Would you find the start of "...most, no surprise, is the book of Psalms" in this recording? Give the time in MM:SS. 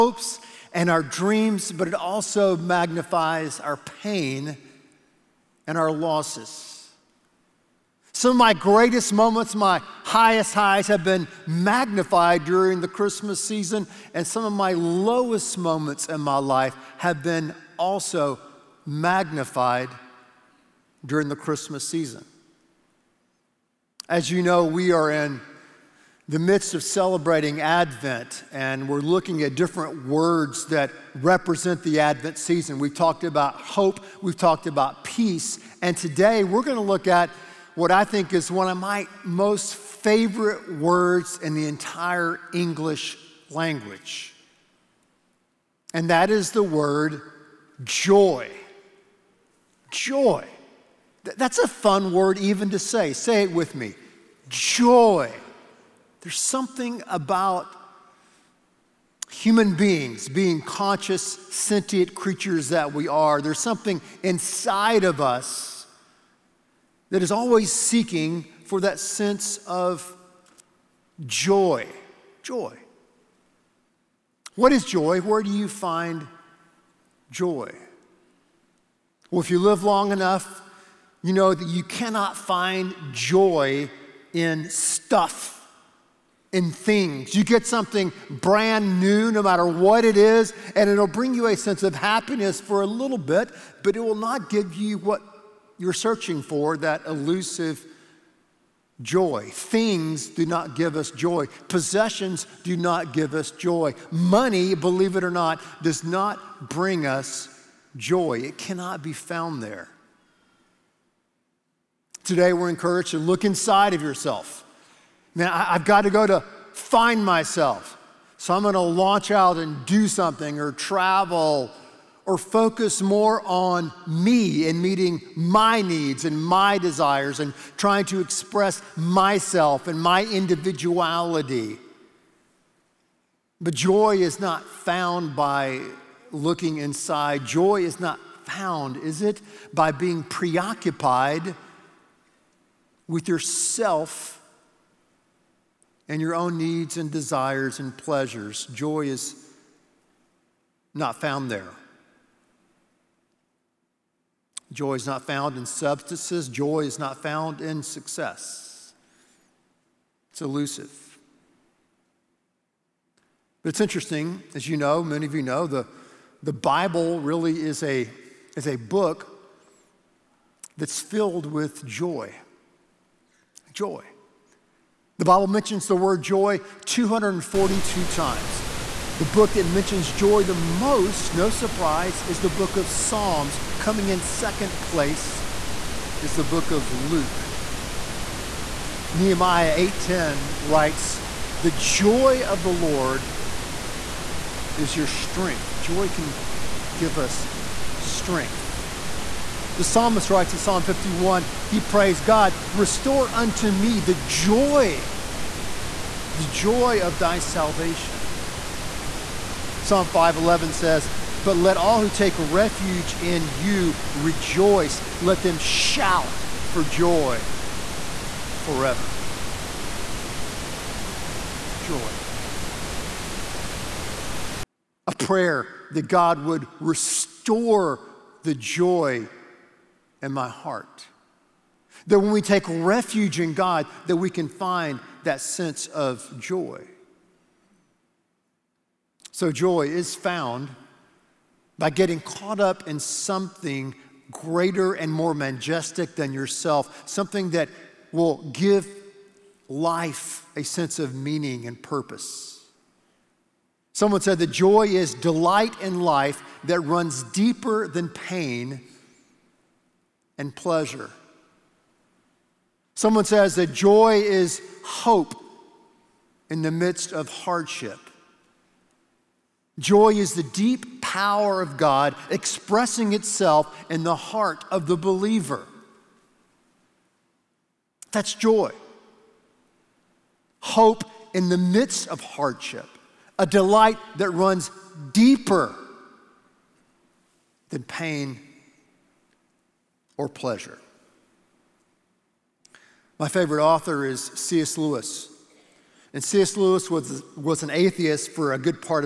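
03:00.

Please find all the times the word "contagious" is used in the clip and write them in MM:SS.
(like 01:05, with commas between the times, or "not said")
not said.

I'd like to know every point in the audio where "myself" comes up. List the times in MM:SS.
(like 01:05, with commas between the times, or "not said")
01:57, 02:08.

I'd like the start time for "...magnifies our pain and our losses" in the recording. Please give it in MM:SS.
00:02.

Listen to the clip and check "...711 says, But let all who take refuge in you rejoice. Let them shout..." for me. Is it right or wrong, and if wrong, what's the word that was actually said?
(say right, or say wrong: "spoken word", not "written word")
wrong: "511", not "711".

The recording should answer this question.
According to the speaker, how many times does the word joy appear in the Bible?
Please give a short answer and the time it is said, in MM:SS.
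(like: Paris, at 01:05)
242, at 02:56.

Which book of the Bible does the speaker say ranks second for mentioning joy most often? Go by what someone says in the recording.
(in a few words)
Luke.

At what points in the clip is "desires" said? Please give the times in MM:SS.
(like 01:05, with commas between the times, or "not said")
02:06, 02:27.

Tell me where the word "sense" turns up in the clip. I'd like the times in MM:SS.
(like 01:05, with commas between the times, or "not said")
01:09, 01:31, 03:55, 04:10.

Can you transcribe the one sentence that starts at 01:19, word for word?
Well, if you live long enough, you know that you cannot find joy in stuff in things.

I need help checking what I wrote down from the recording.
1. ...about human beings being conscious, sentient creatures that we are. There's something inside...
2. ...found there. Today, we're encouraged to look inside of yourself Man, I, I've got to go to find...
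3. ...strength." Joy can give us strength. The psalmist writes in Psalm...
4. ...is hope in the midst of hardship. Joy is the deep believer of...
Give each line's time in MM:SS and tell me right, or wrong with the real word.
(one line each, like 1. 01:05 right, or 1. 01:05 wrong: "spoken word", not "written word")
1. 00:57 right
2. 01:49 right
3. 03:15 right
4. 04:24 wrong: "power", not "believer".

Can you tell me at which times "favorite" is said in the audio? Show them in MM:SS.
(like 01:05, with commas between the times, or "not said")
00:39, 04:53.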